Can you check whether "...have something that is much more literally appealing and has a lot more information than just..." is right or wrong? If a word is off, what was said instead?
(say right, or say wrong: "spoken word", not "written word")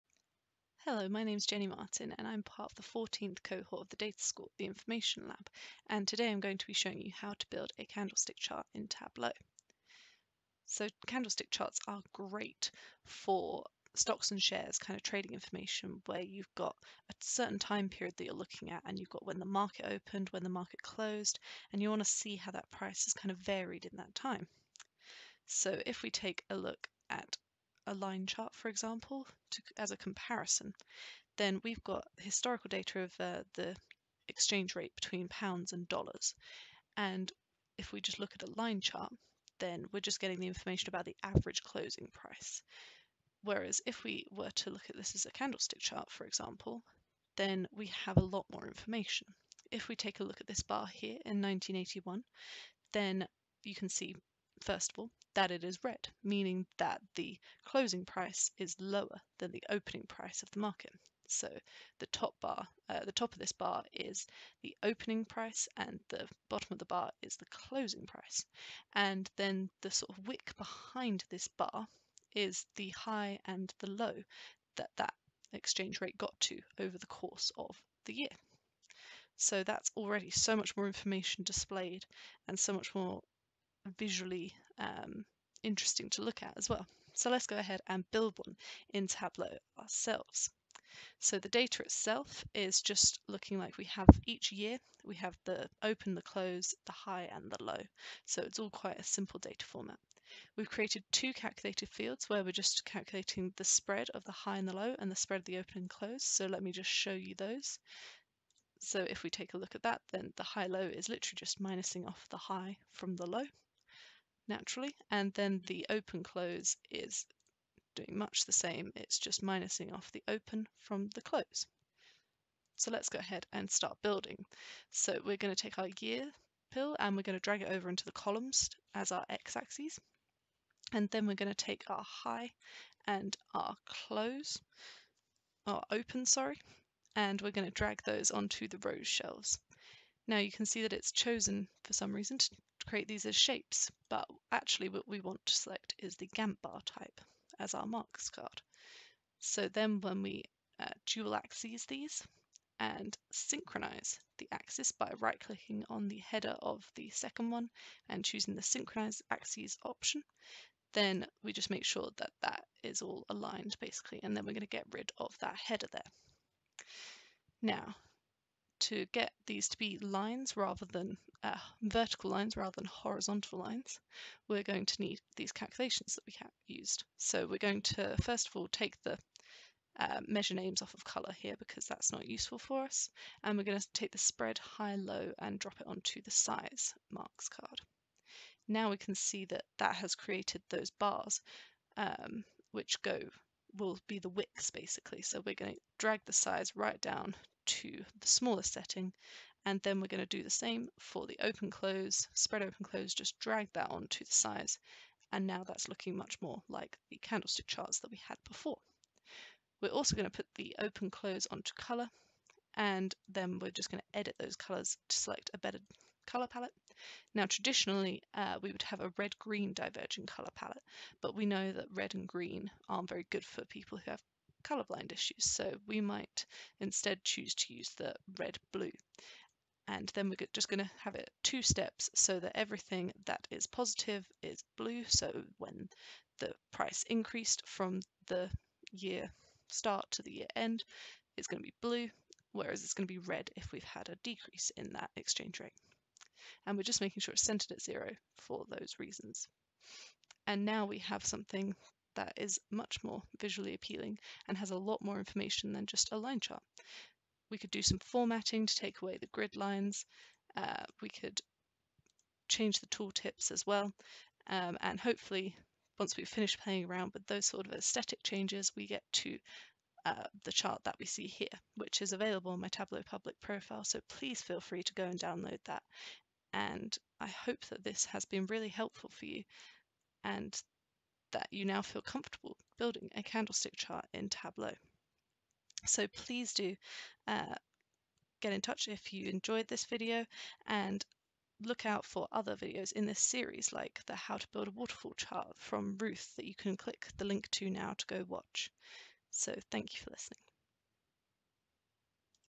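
wrong: "visually", not "literally".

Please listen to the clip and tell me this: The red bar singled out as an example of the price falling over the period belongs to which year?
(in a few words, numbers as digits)
1981.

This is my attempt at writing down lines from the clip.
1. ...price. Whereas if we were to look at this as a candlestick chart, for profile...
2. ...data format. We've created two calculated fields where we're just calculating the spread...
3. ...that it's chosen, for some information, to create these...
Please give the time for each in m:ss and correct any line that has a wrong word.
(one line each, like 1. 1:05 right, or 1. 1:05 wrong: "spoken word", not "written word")
1. 0:42 wrong: "example", not "profile"
2. 1:39 right
3. 2:20 wrong: "reason", not "information".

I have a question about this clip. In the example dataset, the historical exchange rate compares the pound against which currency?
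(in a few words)
Dollars.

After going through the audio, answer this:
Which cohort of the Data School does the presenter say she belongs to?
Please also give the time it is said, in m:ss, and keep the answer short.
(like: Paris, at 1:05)
14th, at 0:02.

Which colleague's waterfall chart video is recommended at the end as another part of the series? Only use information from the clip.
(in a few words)
Ruth.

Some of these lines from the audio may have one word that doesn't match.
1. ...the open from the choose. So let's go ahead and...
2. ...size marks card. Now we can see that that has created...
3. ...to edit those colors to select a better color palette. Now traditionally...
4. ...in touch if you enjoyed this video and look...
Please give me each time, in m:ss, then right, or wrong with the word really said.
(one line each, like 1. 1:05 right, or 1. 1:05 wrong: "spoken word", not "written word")
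1. 2:00 wrong: "close", not "choose"
2. 3:06 right
3. 3:34 right
4. 4:48 right.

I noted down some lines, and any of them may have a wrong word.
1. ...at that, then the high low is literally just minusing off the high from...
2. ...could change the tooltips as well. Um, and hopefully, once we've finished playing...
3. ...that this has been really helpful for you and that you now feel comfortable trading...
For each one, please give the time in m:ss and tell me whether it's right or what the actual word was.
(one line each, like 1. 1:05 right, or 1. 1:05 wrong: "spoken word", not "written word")
1. 1:49 right
2. 4:21 right
3. 4:37 wrong: "building", not "trading".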